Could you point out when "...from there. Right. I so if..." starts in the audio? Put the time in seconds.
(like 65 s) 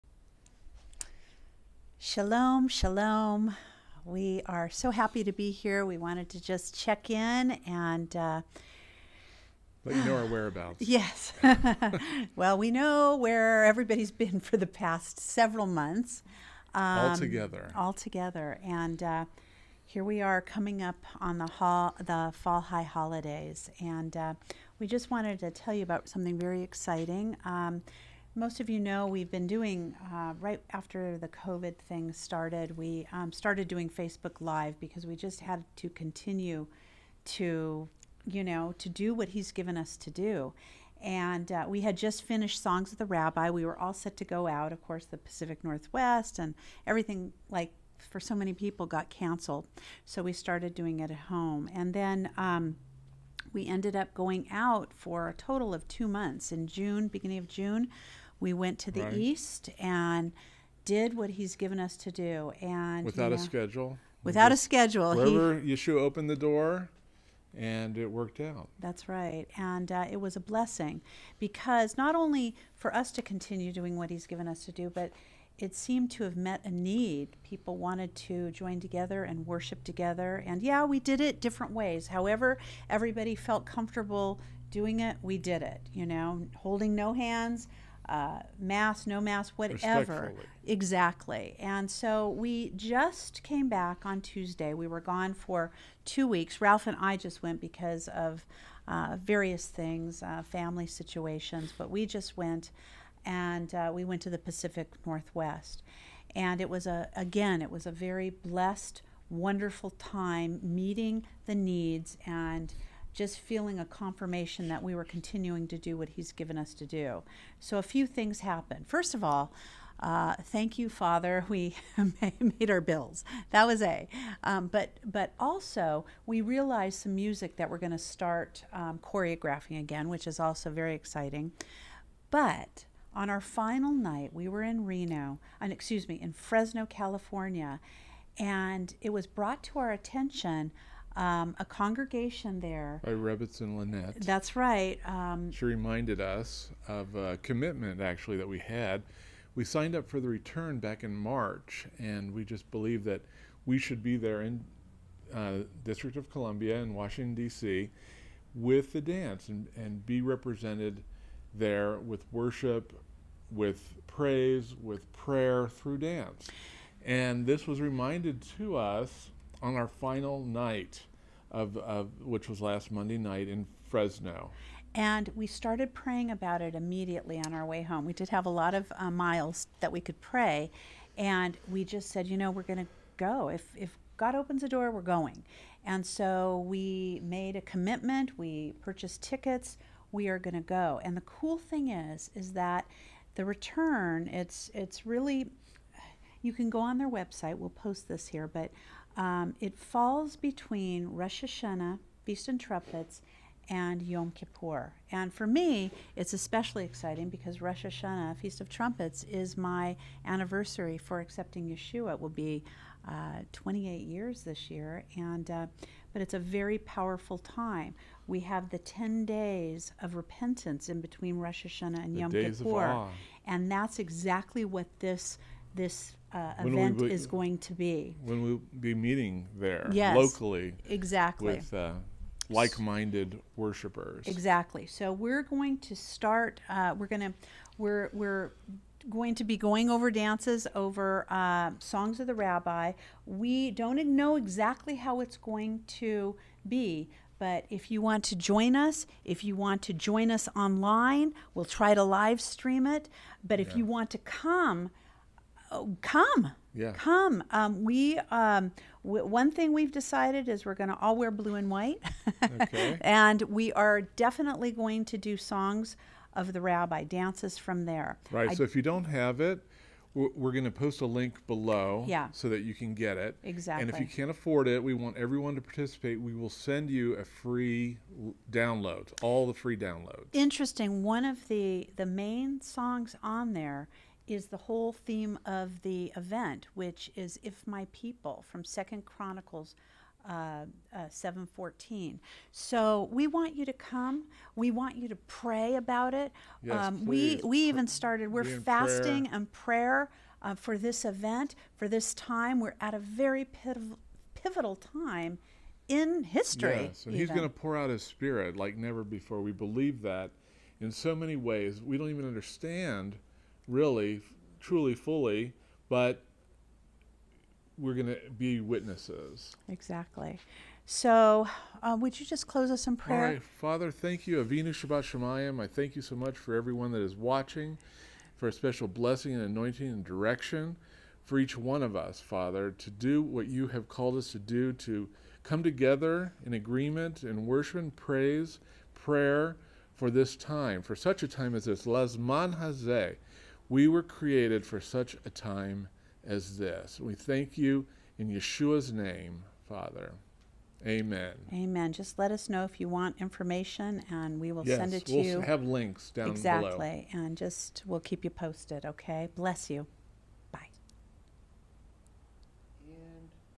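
267 s.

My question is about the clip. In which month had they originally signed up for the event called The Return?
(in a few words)
March.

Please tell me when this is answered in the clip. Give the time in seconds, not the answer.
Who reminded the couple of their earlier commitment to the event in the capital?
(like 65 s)
143 s.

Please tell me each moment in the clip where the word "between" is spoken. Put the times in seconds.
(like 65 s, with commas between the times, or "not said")
200 s, 221 s.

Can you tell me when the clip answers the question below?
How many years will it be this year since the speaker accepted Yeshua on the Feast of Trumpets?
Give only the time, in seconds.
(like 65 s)
213 s.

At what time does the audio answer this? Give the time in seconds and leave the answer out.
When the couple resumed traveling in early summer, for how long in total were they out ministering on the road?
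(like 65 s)
55 s.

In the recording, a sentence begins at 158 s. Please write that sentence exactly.
with the dance and, and be represented there with worship, with praise, with prayer through dance.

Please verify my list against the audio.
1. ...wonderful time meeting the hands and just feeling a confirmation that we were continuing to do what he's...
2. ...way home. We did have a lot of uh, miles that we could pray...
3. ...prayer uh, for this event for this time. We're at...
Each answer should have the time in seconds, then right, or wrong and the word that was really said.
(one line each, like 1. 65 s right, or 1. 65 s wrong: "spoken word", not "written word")
1. 109 s wrong: "needs", not "hands"
2. 177 s right
3. 299 s right.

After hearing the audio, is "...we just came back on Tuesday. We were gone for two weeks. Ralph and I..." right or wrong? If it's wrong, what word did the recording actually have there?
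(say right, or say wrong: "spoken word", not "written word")
right.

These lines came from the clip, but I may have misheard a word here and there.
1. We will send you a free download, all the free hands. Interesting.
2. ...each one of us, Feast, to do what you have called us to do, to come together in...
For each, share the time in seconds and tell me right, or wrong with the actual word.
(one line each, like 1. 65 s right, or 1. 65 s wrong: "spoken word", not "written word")
1. 276 s wrong: "downloads", not "hands"
2. 331 s wrong: "Father", not "Feast".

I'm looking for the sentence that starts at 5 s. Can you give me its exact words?
We wanted to just check in and uh, let you know our whereabouts.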